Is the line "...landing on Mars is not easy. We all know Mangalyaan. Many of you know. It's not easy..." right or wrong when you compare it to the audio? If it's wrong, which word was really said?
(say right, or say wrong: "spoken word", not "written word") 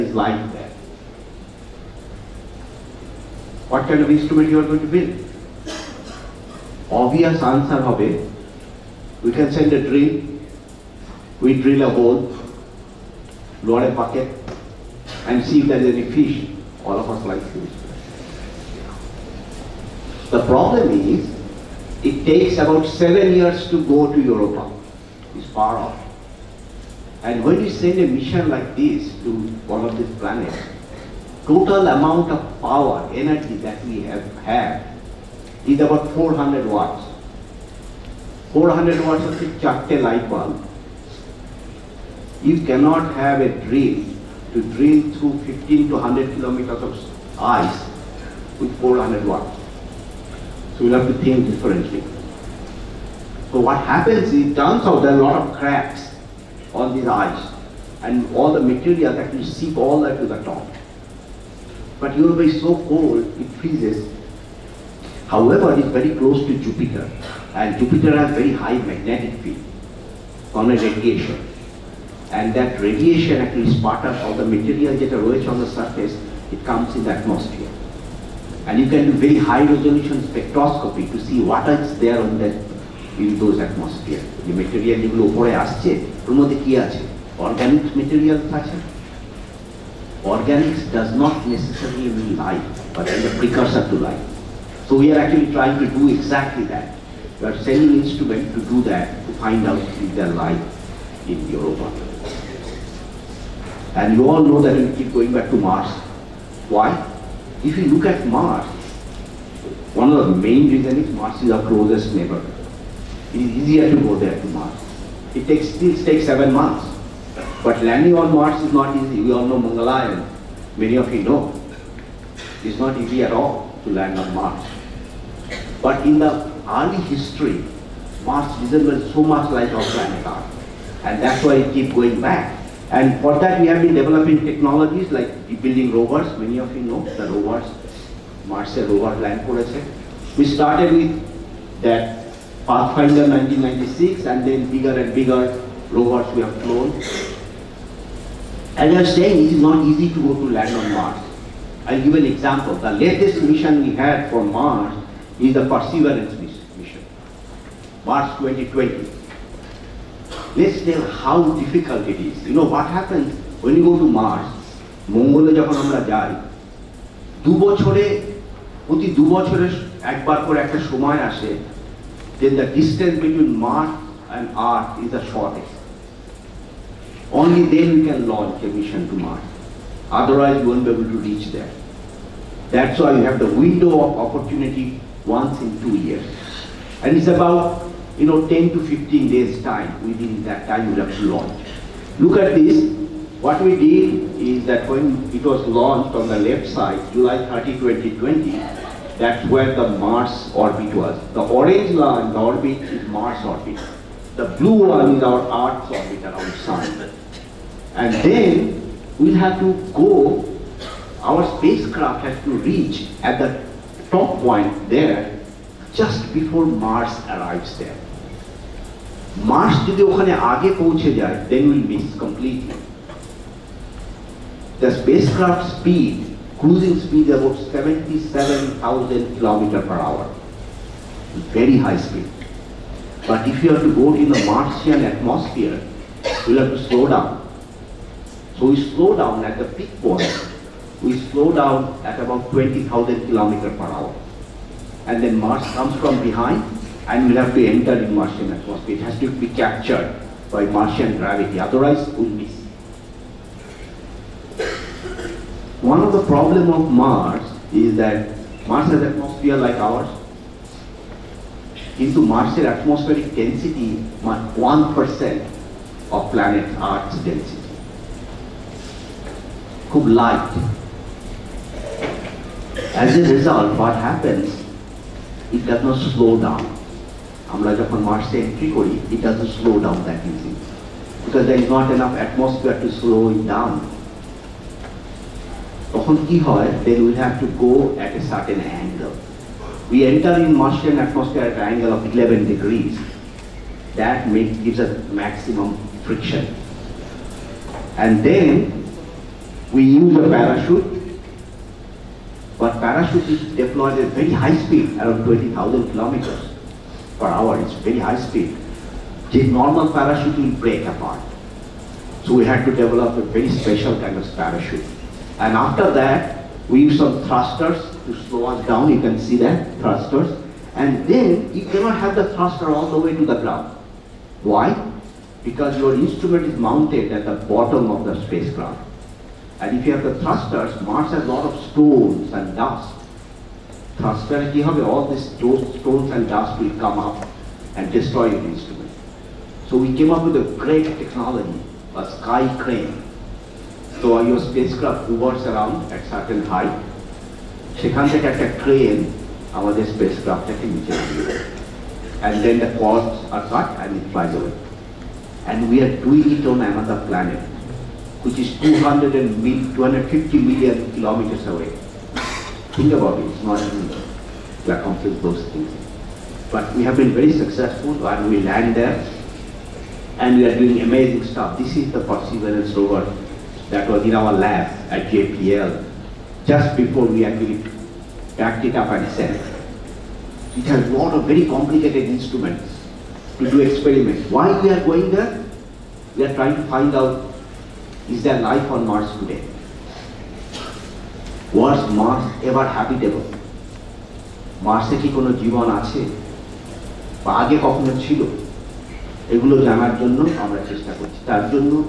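right.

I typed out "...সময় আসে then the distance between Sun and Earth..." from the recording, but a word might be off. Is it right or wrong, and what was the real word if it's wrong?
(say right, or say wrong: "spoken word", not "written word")
wrong: "Mars", not "Sun".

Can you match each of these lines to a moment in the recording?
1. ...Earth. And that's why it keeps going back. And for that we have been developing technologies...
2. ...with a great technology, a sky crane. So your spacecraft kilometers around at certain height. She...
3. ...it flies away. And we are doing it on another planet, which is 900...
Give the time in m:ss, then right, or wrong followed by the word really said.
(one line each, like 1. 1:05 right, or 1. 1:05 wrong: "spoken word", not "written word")
1. 2:10 right
2. 5:40 wrong: "hovers", not "kilometers"
3. 5:53 wrong: "200", not "900".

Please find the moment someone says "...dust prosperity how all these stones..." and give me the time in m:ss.
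5:32.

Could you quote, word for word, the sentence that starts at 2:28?
As I was saying, it is not easy to go to land on Mars.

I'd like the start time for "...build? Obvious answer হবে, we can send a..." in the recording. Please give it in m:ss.
0:04.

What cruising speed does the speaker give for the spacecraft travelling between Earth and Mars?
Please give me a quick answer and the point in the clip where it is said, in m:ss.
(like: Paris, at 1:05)
77,000 km/h, at 3:47.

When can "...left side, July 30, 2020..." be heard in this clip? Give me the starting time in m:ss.
3:16.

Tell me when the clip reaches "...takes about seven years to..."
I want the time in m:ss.
0:22.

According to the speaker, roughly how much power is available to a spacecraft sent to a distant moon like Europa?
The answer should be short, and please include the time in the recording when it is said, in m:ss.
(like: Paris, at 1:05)
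400 watts, at 0:35.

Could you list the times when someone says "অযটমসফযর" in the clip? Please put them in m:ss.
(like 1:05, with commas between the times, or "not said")
4:42, 4:50.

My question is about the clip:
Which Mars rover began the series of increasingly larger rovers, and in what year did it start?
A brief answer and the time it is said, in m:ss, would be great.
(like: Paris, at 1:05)
Pathfinder 1996, at 2:22.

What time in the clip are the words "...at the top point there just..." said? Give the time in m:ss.
3:33.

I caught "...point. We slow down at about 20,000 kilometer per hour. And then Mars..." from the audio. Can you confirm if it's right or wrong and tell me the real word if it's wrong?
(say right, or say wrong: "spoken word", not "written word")
right.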